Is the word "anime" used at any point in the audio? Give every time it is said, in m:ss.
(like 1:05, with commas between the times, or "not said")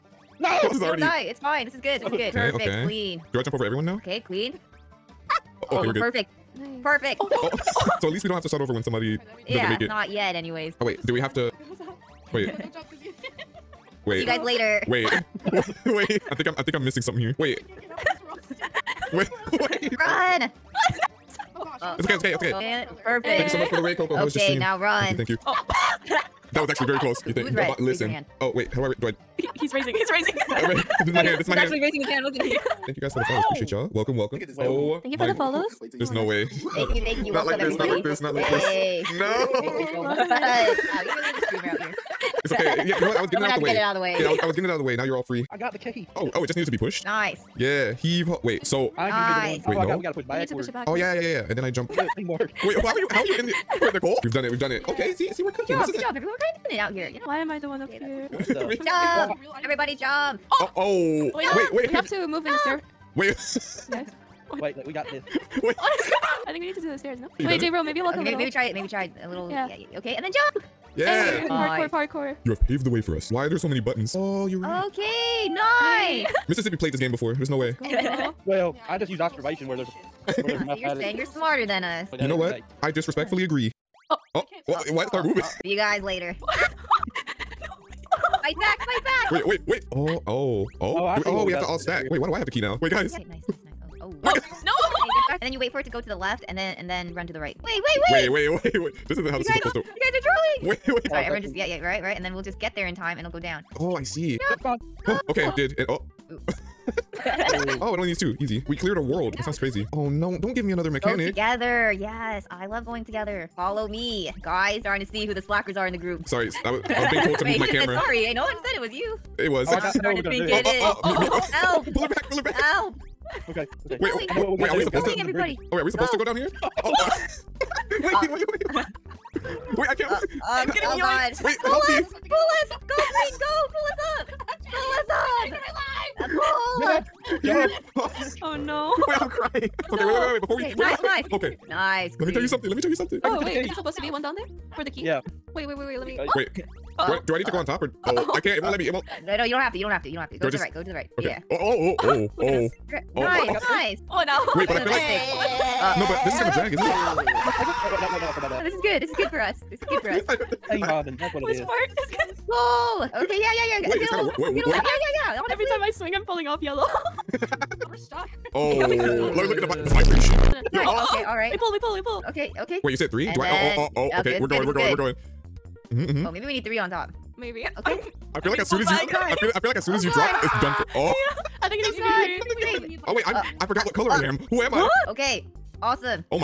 not said.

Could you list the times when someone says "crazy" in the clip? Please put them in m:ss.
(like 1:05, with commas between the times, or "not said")
1:49.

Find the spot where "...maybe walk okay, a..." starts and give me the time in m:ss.
1:07.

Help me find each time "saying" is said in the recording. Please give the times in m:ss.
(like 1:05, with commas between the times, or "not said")
1:20.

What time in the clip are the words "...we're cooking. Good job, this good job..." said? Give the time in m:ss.
0:55.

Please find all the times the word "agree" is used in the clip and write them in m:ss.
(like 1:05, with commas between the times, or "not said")
1:23.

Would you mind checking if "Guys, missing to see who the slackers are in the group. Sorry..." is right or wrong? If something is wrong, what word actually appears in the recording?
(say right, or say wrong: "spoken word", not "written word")
wrong: "starting", not "missing".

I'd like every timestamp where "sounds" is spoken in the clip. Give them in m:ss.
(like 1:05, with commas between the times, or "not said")
1:49.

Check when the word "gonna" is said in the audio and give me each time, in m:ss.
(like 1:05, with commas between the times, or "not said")
2:00, 2:36.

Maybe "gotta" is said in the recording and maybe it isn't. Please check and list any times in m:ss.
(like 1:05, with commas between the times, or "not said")
0:50.